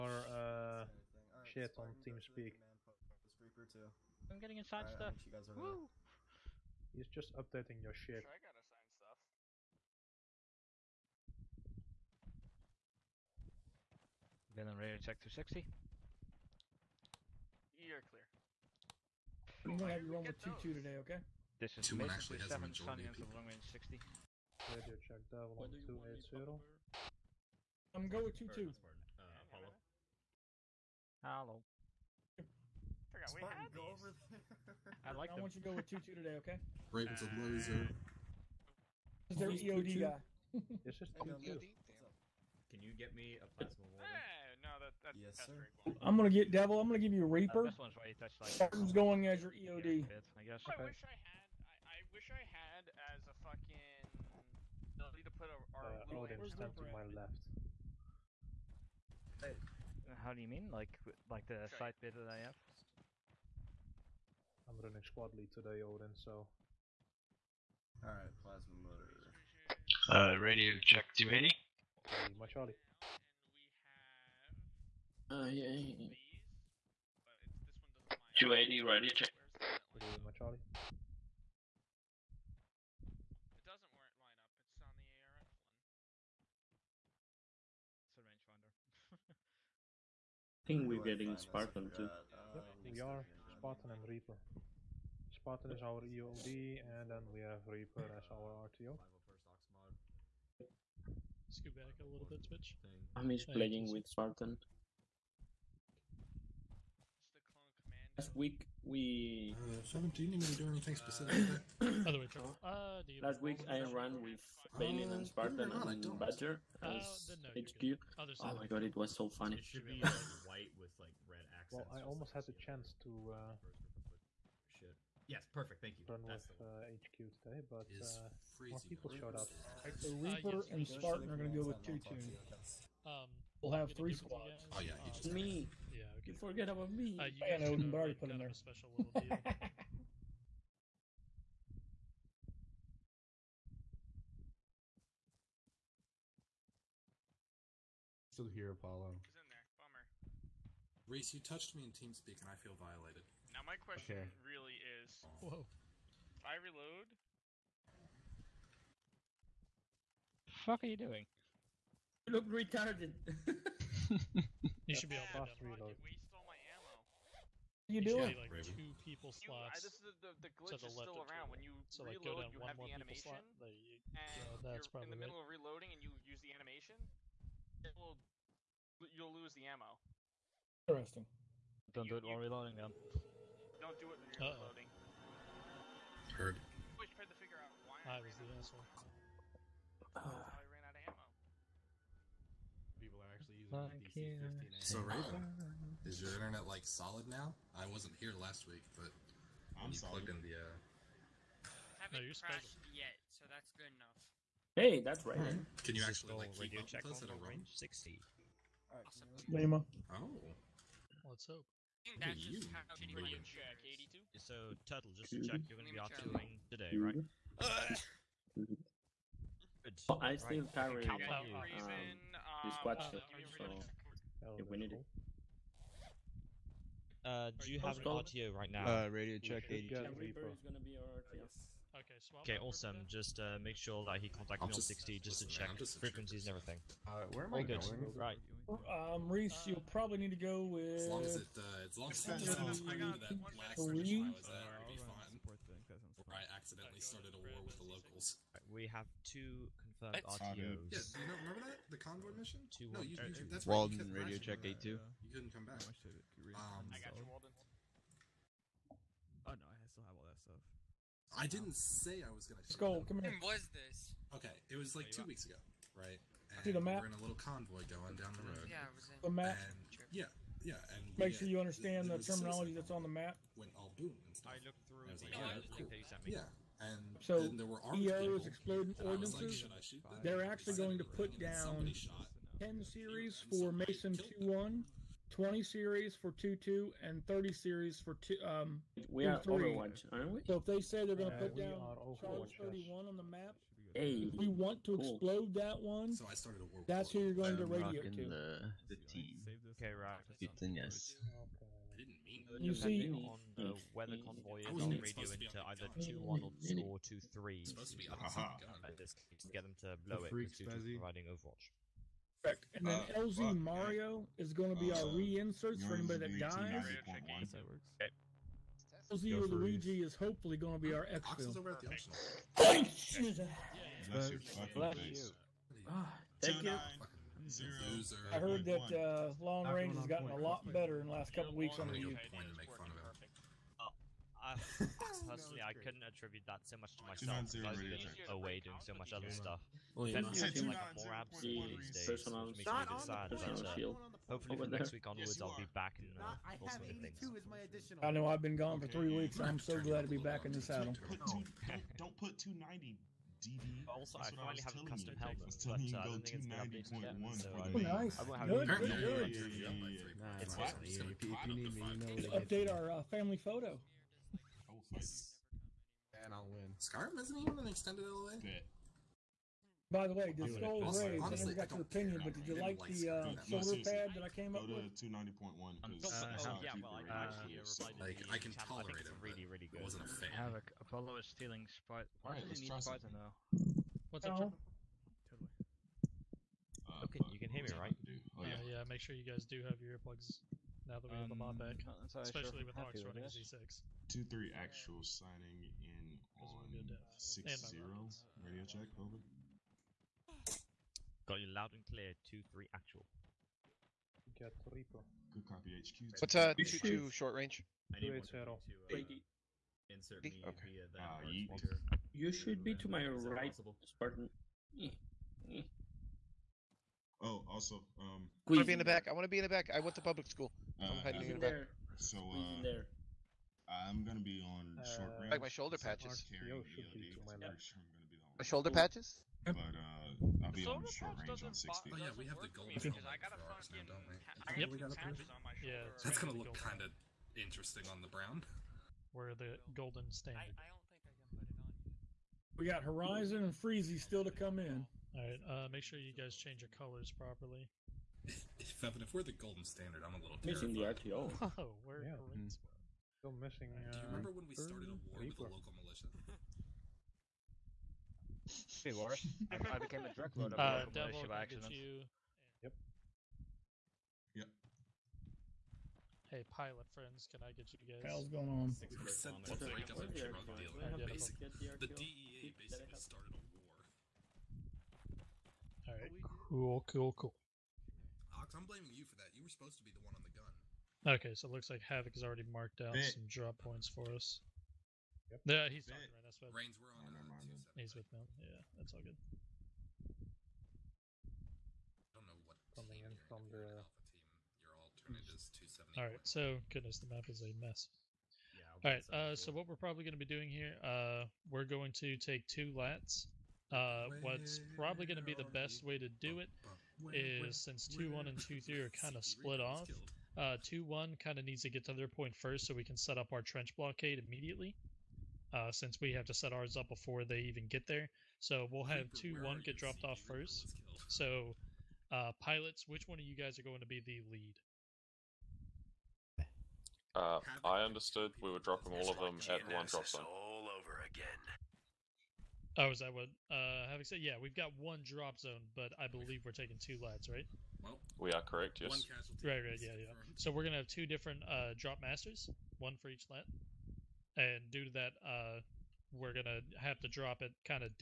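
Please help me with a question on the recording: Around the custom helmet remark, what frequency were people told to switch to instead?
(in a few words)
290.1.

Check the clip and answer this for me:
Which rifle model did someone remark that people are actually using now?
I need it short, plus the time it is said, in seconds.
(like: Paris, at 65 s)
DC-15, at 192 s.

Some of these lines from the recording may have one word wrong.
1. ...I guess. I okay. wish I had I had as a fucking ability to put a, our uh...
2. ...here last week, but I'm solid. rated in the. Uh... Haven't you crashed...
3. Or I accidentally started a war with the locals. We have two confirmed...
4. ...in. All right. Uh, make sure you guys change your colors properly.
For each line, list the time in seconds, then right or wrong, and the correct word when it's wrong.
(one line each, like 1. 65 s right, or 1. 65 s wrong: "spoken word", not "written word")
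1. 50 s right
2. 198 s wrong: "plugged", not "rated"
3. 246 s right
4. 444 s right.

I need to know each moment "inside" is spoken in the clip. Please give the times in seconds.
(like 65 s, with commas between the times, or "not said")
4 s.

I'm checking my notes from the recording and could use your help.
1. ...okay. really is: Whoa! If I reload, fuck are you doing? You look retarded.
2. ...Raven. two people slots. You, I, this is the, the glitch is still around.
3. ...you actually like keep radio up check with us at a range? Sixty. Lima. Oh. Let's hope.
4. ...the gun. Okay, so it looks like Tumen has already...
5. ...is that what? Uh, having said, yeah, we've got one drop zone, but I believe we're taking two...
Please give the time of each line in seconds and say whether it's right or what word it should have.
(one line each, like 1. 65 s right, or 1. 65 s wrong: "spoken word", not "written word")
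1. 154 s right
2. 168 s right
3. 205 s right
4. 480 s wrong: "Havoc", not "Tumen"
5. 532 s right.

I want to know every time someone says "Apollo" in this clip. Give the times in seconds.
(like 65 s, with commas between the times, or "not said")
29 s, 148 s, 380 s.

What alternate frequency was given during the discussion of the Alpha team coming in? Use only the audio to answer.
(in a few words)
270.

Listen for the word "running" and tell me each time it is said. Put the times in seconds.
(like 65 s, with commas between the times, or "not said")
64 s, 393 s.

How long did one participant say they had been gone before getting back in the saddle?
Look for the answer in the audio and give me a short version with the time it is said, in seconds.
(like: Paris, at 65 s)
three weeks, at 348 s.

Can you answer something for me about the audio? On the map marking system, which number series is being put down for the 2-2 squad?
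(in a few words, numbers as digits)
20 series.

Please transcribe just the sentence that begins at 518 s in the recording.
So we'll have 2-1 get dropped off first.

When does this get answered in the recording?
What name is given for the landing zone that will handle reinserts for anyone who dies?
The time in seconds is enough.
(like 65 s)
313 s.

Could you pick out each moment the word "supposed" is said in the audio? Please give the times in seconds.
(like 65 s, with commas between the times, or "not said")
307 s, 479 s.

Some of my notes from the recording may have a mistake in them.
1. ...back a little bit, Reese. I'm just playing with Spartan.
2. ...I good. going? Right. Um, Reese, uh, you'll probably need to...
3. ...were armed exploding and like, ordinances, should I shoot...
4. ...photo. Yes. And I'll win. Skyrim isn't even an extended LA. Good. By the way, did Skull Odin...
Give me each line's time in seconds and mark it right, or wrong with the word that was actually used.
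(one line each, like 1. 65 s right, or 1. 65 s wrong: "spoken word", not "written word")
1. 101 s wrong: "Twitch", not "Reese"
2. 237 s right
3. 277 s right
4. 363 s wrong: "Raise", not "Odin".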